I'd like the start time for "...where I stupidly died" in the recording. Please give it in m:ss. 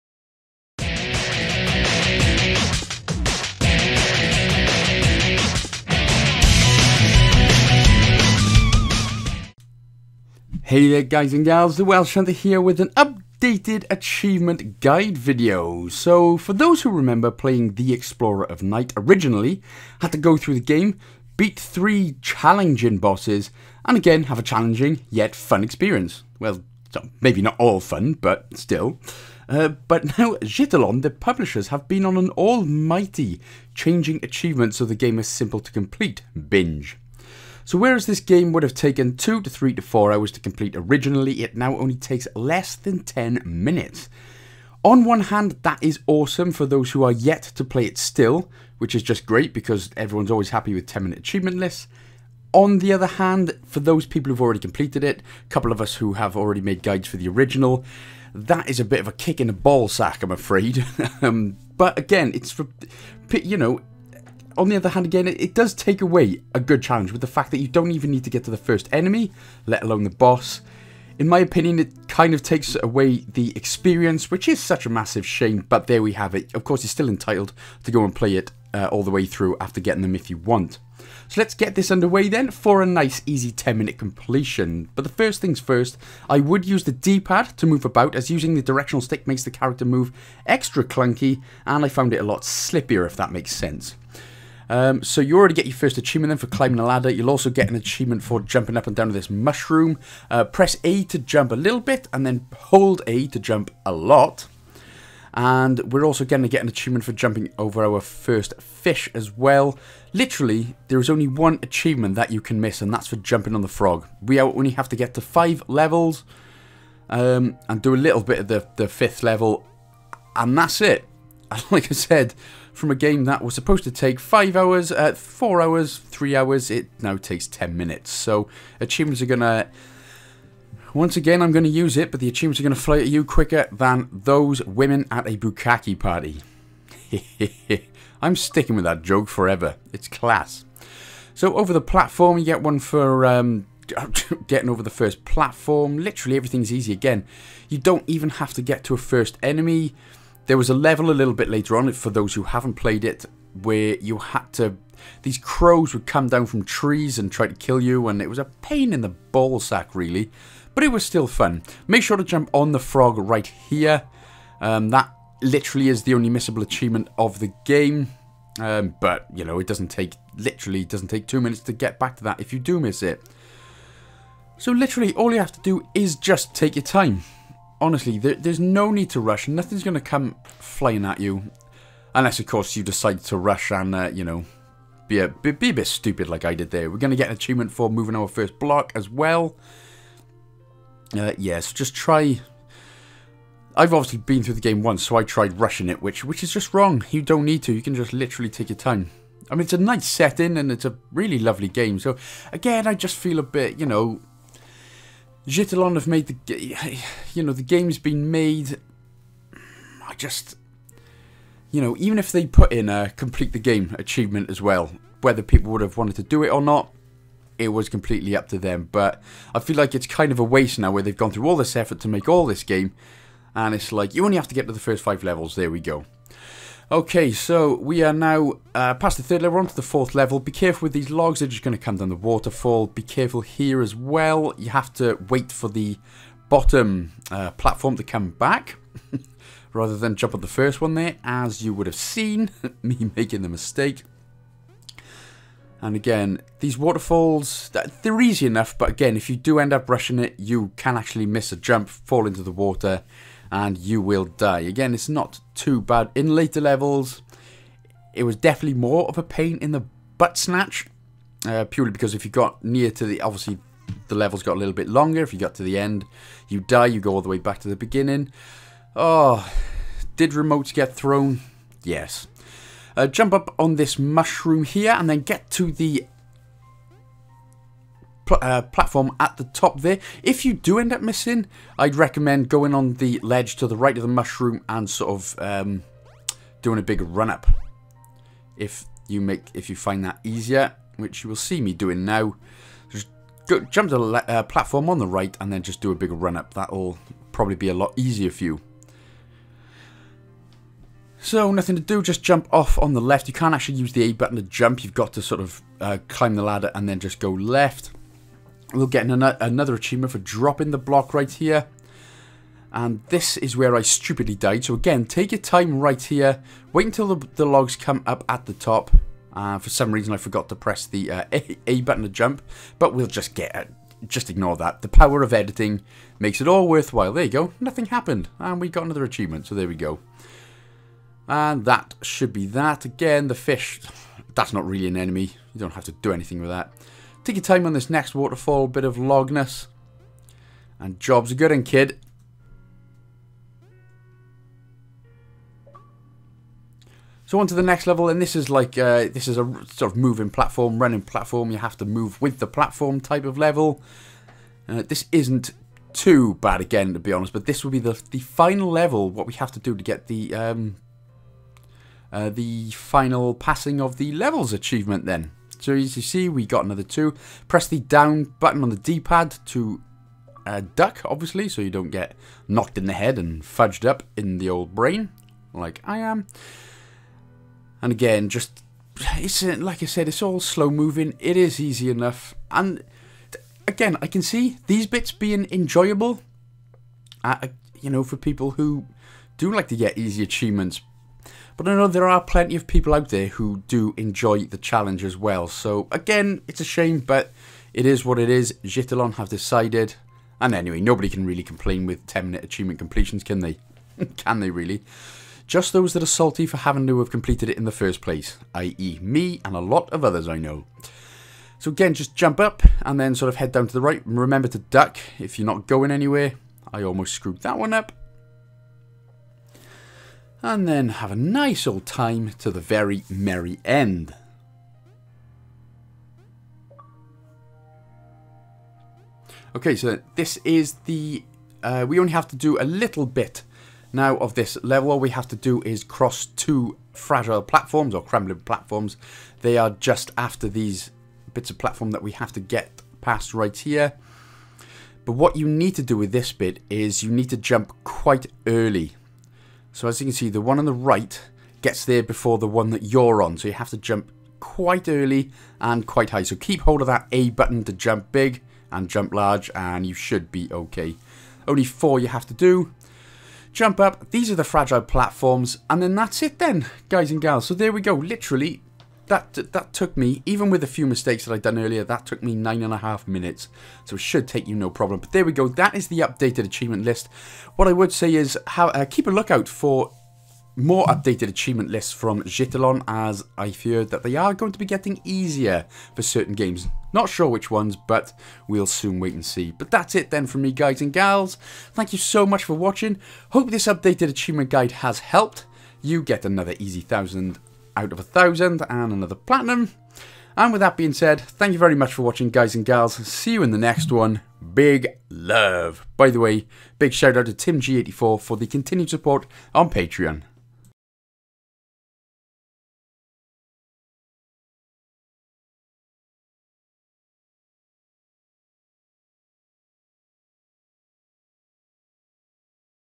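5:13.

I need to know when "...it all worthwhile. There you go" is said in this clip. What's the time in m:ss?
5:26.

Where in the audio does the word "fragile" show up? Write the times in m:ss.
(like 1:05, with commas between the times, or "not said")
7:16, 7:44.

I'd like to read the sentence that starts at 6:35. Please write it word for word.
So again, it's a shame, but it is what it is.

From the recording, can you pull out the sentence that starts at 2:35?
These crows would come down from trees and try to kill you, and it was a pain in the ballsack, really.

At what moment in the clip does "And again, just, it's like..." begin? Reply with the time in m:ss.
6:17.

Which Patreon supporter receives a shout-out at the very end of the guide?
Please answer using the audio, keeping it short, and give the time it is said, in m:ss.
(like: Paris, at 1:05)
Tim G84, at 8:27.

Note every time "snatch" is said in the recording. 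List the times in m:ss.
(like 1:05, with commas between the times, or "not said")
4:20.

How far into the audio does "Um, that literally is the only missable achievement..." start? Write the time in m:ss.
2:44.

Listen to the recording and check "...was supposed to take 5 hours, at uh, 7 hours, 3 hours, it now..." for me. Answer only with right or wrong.
wrong.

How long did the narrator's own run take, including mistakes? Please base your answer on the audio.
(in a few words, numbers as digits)
9 and a half minutes.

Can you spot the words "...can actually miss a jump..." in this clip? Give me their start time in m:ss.
4:10.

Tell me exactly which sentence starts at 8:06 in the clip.
Not sure which ones, but we'll soon wait and see.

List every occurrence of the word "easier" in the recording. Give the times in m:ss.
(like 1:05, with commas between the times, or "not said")
4:50, 4:57, 8:05.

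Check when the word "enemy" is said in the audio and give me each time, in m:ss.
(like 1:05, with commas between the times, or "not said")
1:08, 2:29, 5:34.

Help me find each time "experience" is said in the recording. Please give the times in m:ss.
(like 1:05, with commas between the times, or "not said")
0:25, 1:13.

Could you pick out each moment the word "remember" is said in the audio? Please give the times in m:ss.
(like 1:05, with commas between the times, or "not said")
0:16, 6:54.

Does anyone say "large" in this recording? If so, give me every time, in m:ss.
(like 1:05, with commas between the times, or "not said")
7:39.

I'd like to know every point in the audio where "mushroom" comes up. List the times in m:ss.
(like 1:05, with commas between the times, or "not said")
1:39, 4:33, 4:44.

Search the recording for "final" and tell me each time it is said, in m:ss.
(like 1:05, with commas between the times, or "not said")
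5:58, 6:02.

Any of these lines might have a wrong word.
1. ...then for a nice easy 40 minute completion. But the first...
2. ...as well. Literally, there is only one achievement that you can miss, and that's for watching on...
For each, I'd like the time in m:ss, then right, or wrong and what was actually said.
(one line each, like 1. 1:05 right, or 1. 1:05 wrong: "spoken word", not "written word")
1. 1:22 wrong: "10", not "40"
2. 1:49 wrong: "jumping", not "watching".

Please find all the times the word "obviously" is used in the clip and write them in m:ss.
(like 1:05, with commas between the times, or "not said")
3:13, 4:23, 6:11.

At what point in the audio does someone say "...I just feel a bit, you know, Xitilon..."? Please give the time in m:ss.
3:22.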